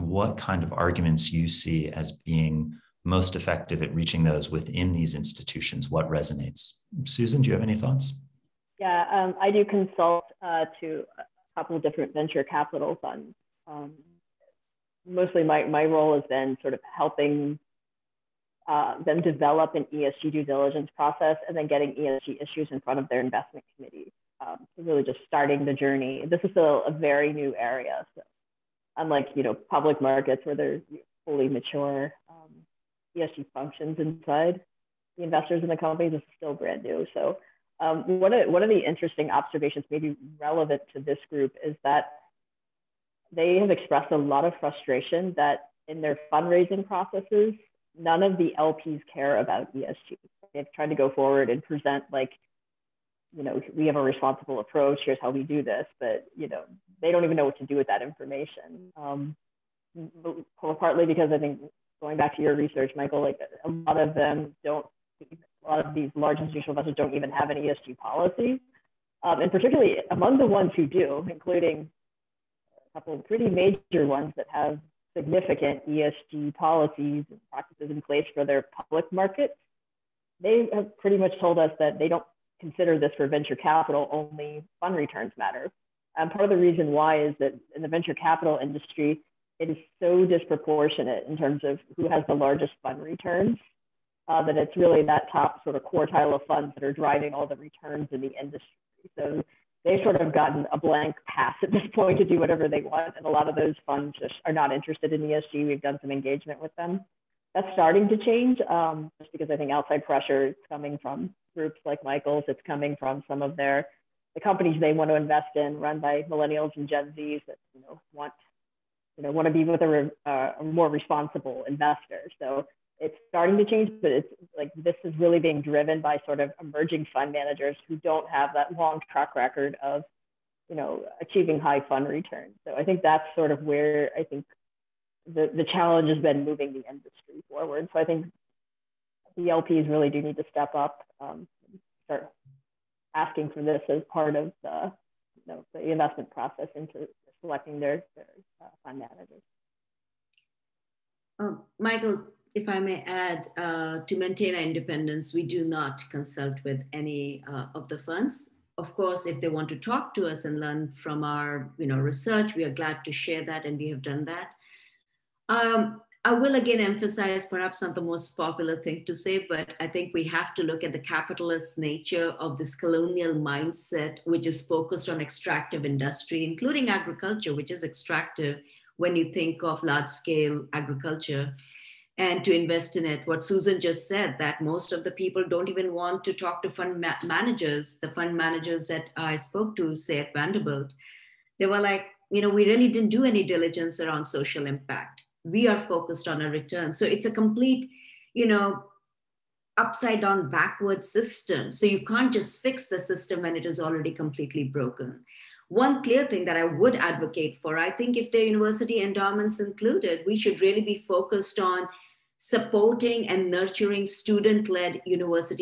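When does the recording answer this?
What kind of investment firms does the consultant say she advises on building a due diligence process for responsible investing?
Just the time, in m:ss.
0:12.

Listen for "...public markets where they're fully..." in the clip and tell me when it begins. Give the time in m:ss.
0:29.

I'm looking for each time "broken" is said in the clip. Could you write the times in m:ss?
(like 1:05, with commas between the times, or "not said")
3:24.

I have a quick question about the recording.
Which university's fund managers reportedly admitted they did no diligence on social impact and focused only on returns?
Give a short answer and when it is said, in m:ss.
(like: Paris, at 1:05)
Vanderbilt, at 3:10.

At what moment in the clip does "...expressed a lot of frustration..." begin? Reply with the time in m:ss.
0:43.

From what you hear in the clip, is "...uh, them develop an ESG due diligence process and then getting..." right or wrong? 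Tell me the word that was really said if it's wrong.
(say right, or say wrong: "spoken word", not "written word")
right.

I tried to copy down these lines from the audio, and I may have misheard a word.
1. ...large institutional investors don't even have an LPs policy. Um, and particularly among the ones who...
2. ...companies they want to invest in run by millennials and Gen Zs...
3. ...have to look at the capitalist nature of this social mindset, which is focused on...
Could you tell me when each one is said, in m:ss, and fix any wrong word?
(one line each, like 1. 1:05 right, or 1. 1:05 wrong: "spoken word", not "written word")
1. 1:06 wrong: "ESG", not "LPs"
2. 1:54 right
3. 2:50 wrong: "colonial", not "social".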